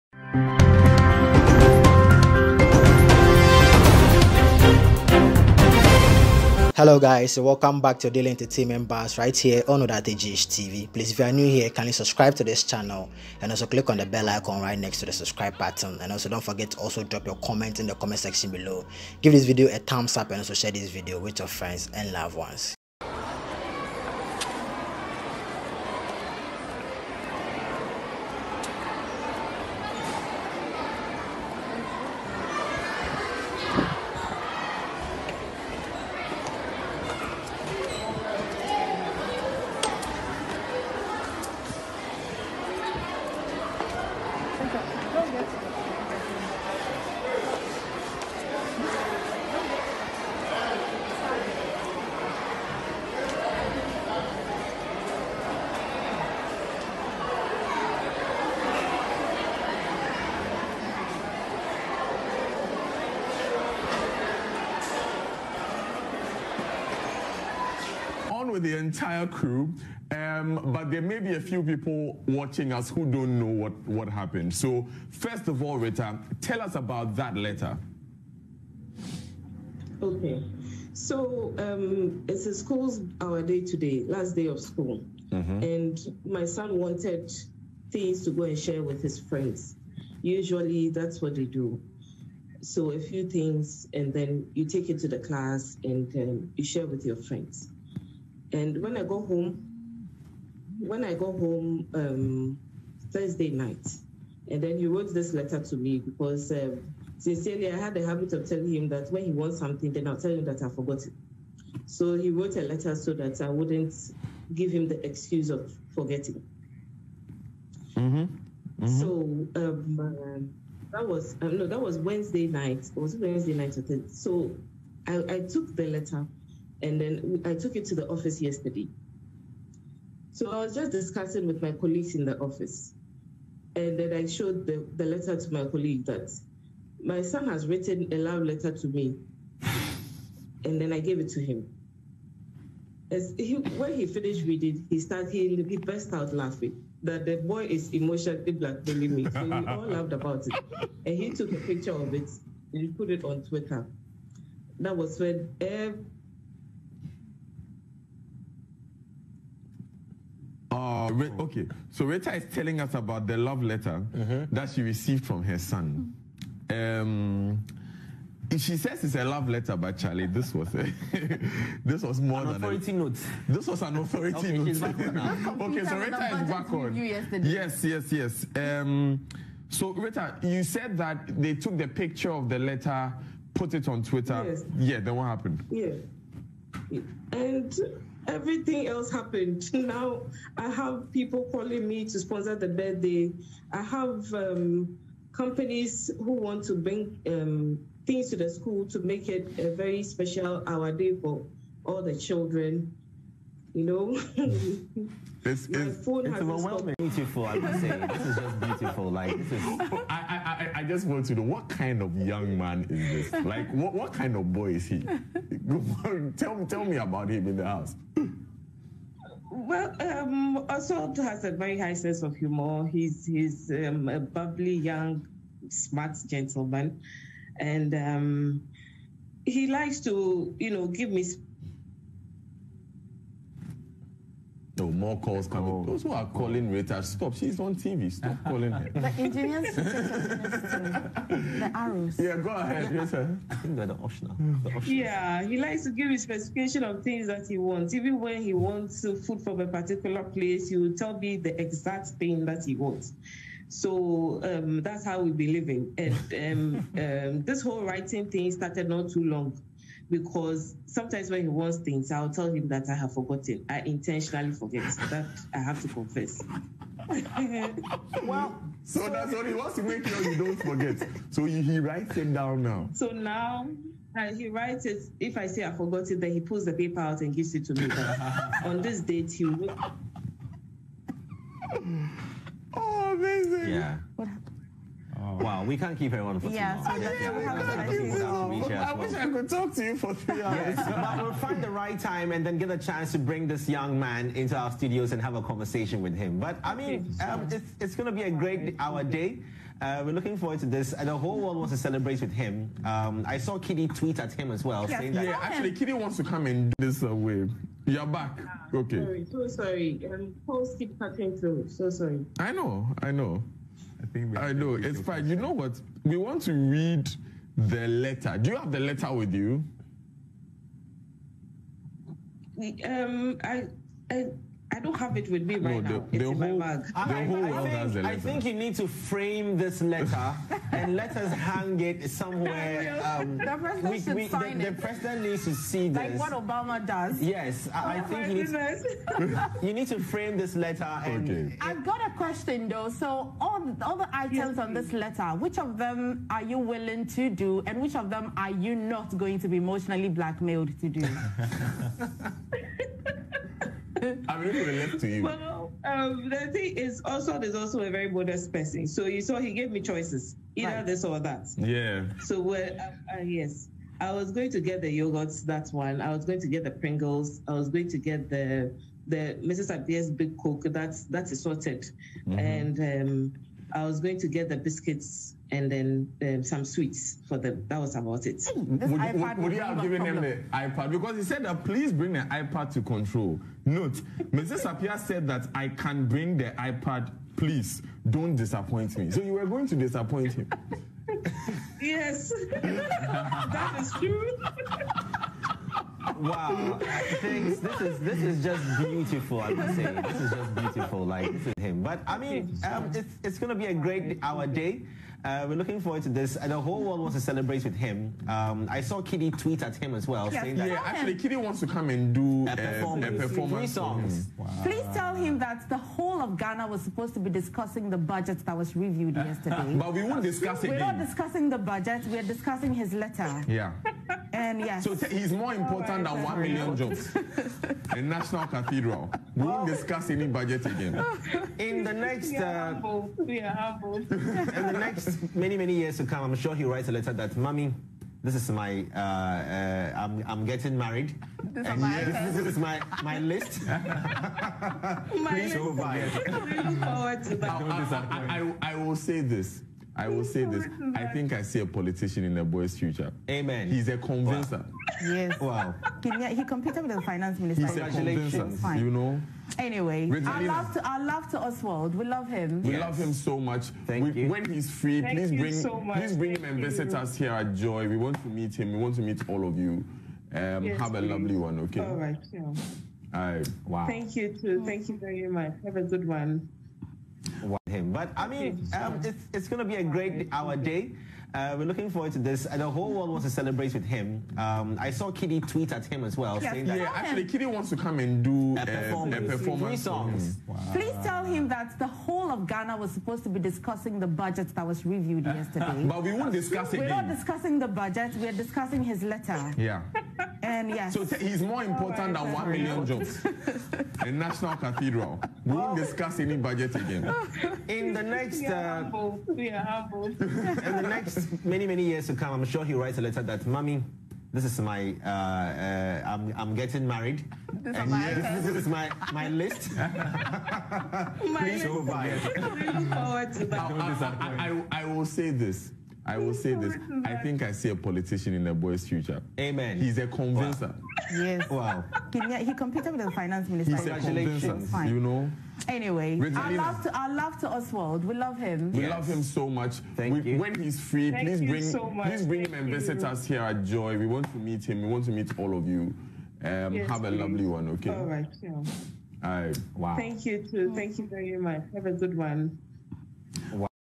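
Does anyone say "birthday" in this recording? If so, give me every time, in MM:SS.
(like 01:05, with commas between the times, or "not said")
03:12.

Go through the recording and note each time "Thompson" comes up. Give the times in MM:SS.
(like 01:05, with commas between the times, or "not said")
not said.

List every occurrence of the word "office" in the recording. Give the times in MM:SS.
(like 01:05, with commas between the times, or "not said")
02:08, 02:12.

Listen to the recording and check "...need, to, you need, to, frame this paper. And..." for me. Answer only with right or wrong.
wrong.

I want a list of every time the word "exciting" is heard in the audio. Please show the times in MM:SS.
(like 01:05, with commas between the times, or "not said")
not said.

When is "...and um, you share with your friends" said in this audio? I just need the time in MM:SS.
01:35.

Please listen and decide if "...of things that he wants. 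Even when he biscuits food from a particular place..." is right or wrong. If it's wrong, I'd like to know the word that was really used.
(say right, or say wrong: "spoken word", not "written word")
wrong: "wants", not "biscuits".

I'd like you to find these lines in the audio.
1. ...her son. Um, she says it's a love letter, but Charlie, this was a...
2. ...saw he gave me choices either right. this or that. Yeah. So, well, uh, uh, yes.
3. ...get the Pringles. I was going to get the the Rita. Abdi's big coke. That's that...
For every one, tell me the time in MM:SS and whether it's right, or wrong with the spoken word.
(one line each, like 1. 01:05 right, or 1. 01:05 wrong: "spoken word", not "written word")
1. 02:45 right
2. 05:59 right
3. 06:06 wrong: "Mrs", not "Rita".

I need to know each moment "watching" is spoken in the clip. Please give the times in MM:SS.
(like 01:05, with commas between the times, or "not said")
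01:12.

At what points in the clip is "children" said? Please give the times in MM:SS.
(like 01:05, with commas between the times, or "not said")
03:22.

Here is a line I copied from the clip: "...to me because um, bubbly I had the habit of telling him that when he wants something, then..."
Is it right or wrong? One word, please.
wrong.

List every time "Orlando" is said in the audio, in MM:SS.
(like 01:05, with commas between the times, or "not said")
not said.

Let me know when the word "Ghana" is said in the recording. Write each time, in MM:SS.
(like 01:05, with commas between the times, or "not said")
06:56, 08:12.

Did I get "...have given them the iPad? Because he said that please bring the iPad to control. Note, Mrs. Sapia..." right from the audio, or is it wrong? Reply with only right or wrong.
right.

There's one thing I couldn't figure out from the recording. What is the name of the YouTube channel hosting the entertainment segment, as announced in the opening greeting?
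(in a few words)
OdarteyGH TV.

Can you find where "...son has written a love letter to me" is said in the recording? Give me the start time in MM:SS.
02:17.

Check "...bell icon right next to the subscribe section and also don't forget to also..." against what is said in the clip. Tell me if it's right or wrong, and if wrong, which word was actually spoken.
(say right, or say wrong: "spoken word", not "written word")
wrong: "button", not "section".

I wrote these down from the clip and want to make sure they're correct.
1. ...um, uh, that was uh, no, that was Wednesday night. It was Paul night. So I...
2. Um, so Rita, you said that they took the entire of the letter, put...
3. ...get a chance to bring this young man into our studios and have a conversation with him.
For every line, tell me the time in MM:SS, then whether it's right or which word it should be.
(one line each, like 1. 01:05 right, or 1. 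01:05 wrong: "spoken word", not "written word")
1. 01:59 wrong: "Wednesday", not "Paul"
2. 02:58 wrong: "picture", not "entire"
3. 04:52 right.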